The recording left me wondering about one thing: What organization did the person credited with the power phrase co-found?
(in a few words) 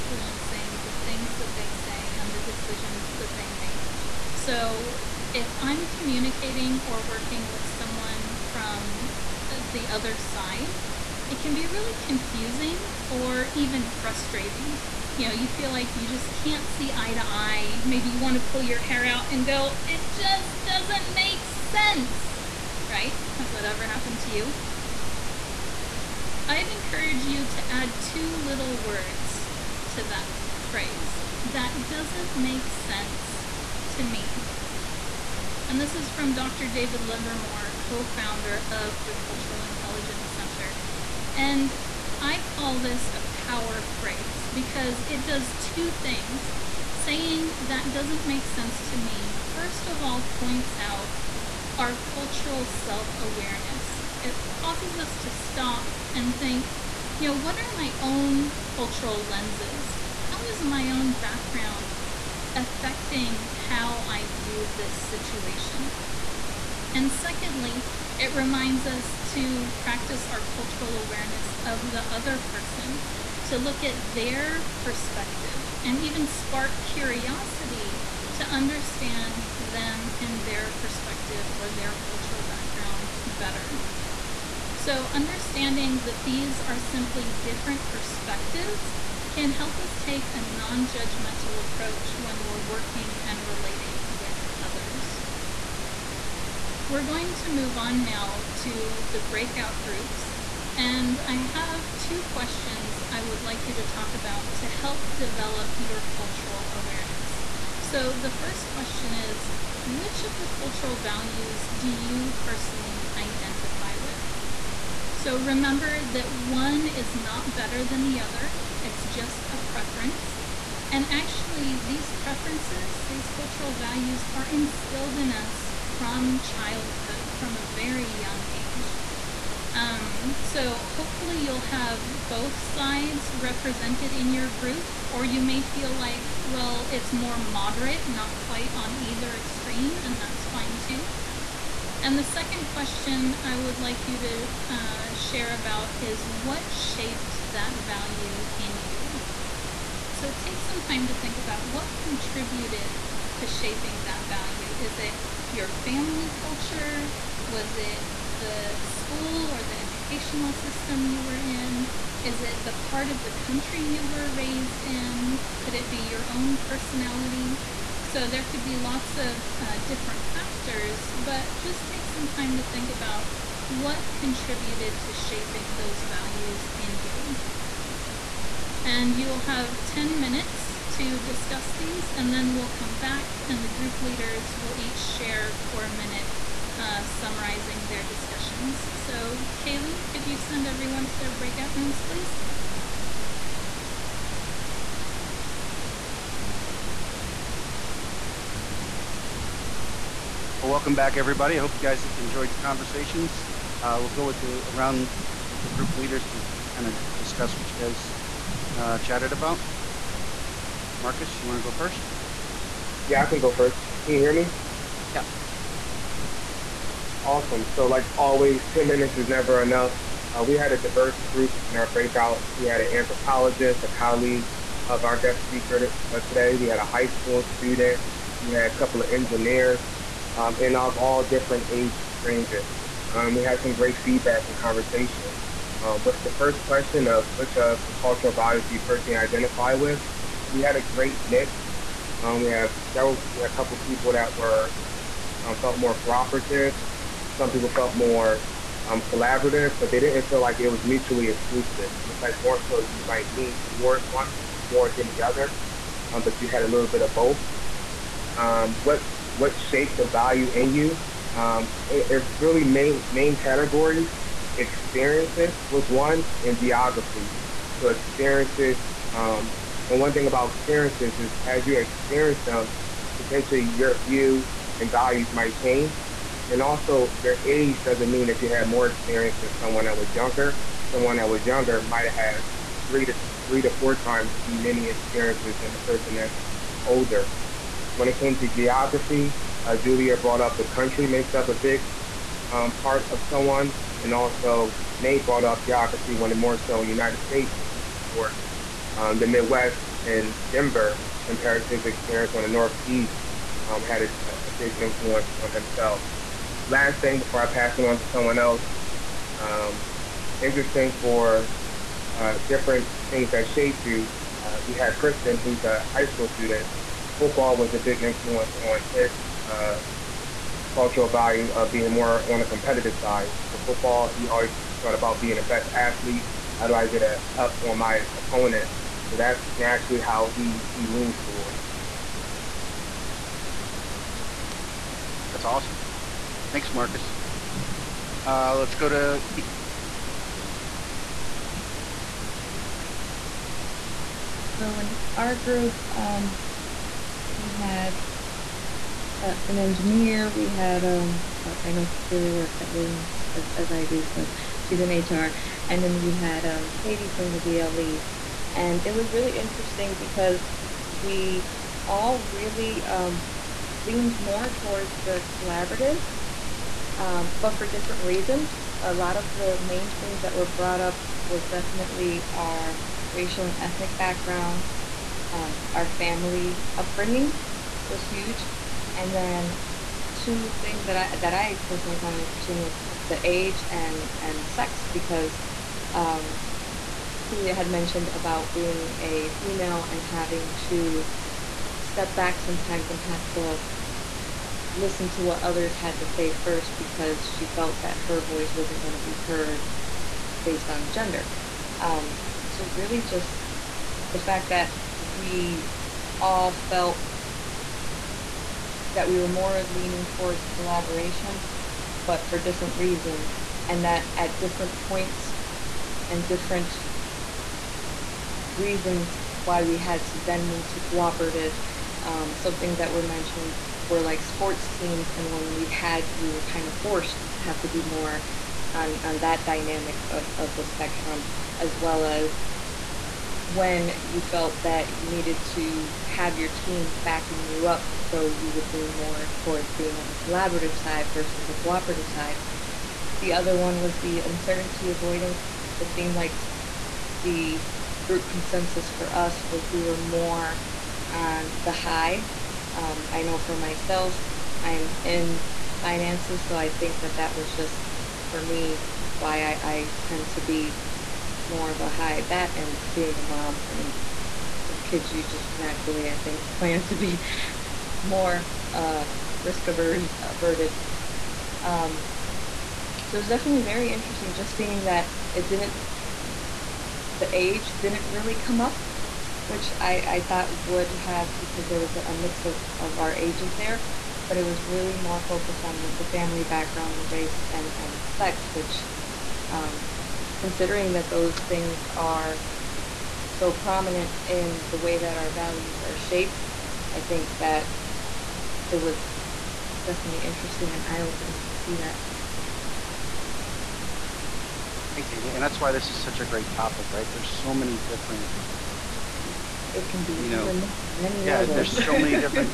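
Cultural Intelligence Center.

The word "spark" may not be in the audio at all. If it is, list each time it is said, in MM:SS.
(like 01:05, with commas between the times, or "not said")
01:16.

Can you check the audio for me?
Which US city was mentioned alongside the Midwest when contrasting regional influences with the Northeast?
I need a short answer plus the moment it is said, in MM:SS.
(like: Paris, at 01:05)
Denver, at 05:00.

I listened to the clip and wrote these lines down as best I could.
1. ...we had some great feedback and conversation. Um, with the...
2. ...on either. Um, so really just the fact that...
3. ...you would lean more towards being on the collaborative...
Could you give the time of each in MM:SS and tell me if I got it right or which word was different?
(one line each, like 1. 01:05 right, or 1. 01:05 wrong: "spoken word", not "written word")
1. 03:53 right
2. 06:40 wrong: "gender", not "either"
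3. 07:18 right.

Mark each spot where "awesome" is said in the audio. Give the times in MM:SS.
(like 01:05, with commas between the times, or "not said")
03:37, 05:35.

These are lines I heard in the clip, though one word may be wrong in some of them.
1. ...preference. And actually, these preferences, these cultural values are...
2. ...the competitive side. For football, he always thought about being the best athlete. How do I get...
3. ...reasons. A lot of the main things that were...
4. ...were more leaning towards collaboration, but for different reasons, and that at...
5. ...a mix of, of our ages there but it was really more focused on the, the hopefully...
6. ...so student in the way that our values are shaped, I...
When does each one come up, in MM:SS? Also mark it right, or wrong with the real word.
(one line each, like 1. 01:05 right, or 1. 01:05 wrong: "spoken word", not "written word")
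1. 01:59 right
2. 05:22 right
3. 06:08 right
4. 06:49 right
5. 08:01 wrong: "family", not "hopefully"
6. 08:13 wrong: "prominent", not "student".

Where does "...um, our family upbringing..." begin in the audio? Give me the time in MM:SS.
06:15.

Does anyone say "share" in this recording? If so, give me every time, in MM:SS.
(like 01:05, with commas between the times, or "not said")
02:25, 03:04.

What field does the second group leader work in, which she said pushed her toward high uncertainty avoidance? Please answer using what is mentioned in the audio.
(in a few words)
Finances.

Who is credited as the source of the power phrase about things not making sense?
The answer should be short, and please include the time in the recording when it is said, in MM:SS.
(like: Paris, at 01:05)
Dr. David Livermore, at 00:36.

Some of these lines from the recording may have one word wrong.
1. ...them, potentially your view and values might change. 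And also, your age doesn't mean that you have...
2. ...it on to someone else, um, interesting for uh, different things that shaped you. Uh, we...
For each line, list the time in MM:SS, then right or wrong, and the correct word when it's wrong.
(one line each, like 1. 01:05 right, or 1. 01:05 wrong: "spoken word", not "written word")
1. 04:32 right
2. 05:07 right.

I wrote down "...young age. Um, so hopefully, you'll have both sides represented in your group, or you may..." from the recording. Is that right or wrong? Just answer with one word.
right.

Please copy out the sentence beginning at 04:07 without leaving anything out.
Some people felt more um, collaborative, but they didn't feel like it was mutually exclusive.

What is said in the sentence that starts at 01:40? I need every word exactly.
And I have two questions I would like you to talk about to help develop your cultural awareness.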